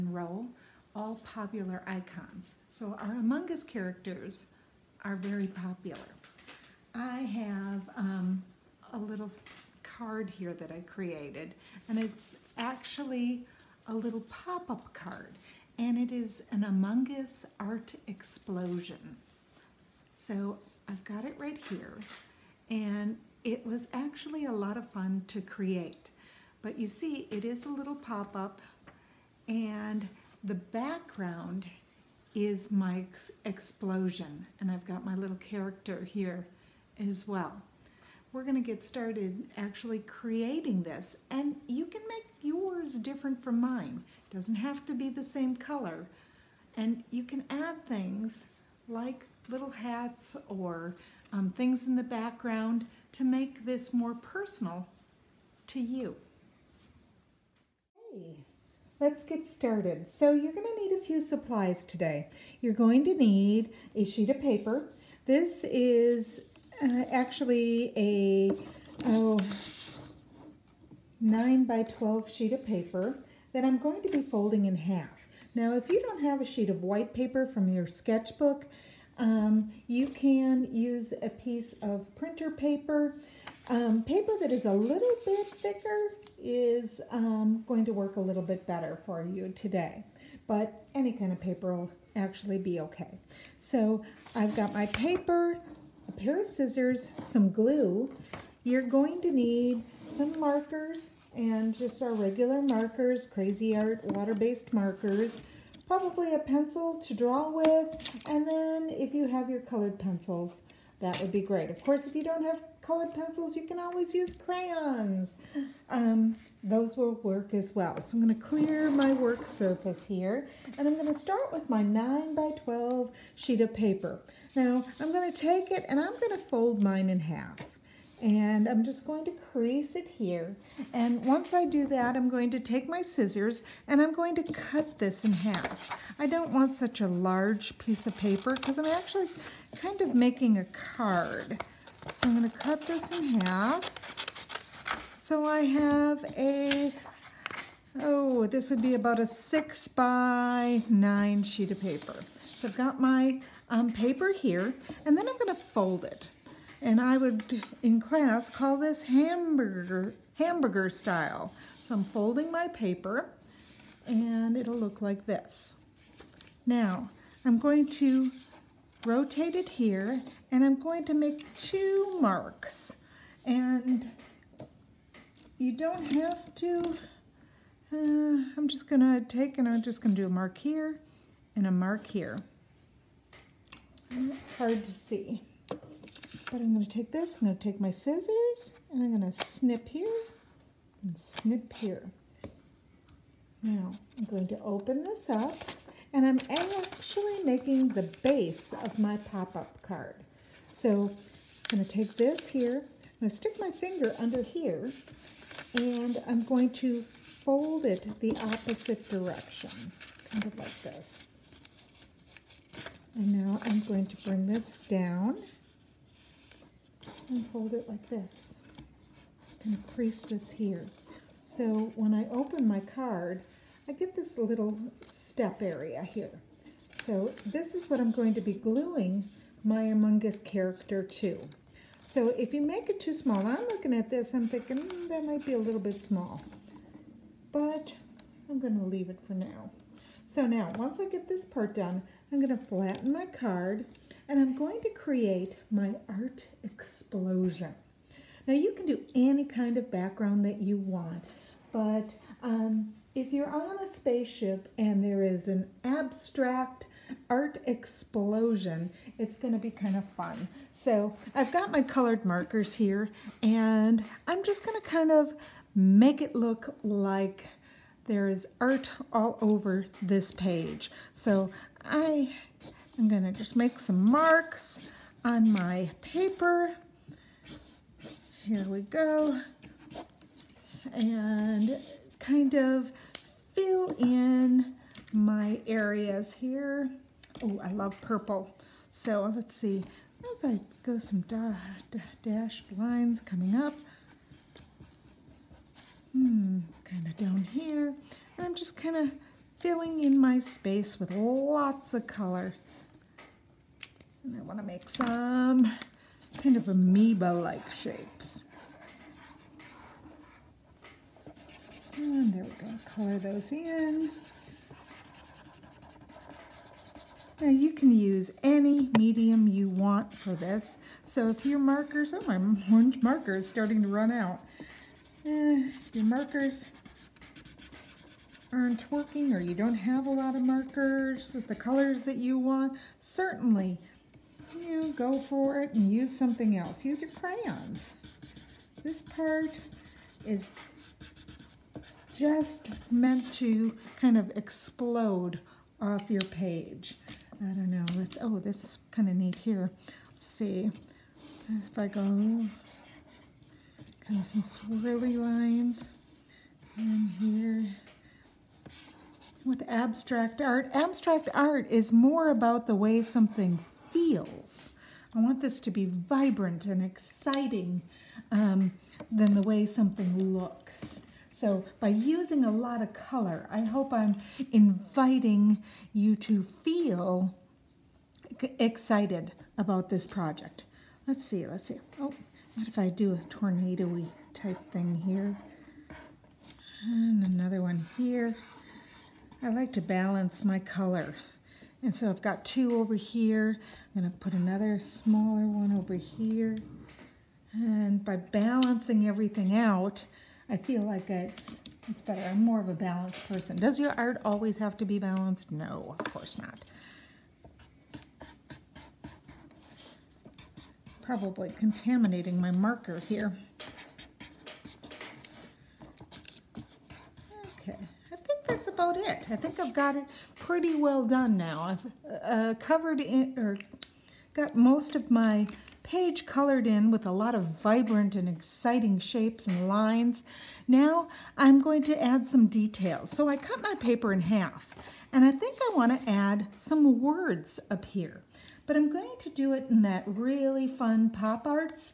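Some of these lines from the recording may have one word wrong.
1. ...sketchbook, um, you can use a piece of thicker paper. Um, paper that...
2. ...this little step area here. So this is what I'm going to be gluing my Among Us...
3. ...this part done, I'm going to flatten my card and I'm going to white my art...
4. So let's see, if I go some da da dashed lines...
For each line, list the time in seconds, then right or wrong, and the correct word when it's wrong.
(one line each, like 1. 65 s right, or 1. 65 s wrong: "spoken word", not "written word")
1. 77 s wrong: "printer", not "thicker"
2. 224 s right
3. 241 s wrong: "create", not "white"
4. 288 s right.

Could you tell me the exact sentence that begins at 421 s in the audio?
I've uh, covered in, or got most of my page colored in with a lot of vibrant and exciting shapes and lines.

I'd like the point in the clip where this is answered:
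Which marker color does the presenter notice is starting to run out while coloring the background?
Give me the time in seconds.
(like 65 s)
322 s.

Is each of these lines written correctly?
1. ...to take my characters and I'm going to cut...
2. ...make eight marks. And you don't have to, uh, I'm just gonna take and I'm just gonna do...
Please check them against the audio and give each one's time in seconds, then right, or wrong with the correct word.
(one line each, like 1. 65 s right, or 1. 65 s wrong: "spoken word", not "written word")
1. 132 s wrong: "scissors", not "characters"
2. 171 s wrong: "two", not "eight".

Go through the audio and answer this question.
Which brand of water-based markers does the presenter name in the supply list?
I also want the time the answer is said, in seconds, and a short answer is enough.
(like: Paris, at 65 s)
Crazy Art, at 103 s.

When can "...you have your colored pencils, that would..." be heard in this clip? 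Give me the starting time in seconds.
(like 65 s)
109 s.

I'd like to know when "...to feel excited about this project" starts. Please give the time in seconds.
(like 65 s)
376 s.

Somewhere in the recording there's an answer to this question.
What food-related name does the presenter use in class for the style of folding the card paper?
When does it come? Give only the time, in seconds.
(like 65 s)
160 s.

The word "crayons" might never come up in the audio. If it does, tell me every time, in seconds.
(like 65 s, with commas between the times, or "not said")
114 s, 337 s.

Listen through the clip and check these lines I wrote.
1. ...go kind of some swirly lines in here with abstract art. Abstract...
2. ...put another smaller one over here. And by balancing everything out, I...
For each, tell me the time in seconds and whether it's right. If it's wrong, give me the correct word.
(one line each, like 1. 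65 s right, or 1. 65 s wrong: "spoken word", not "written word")
1. 351 s right
2. 394 s right.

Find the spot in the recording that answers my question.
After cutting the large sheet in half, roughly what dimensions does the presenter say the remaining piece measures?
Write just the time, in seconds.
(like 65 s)
149 s.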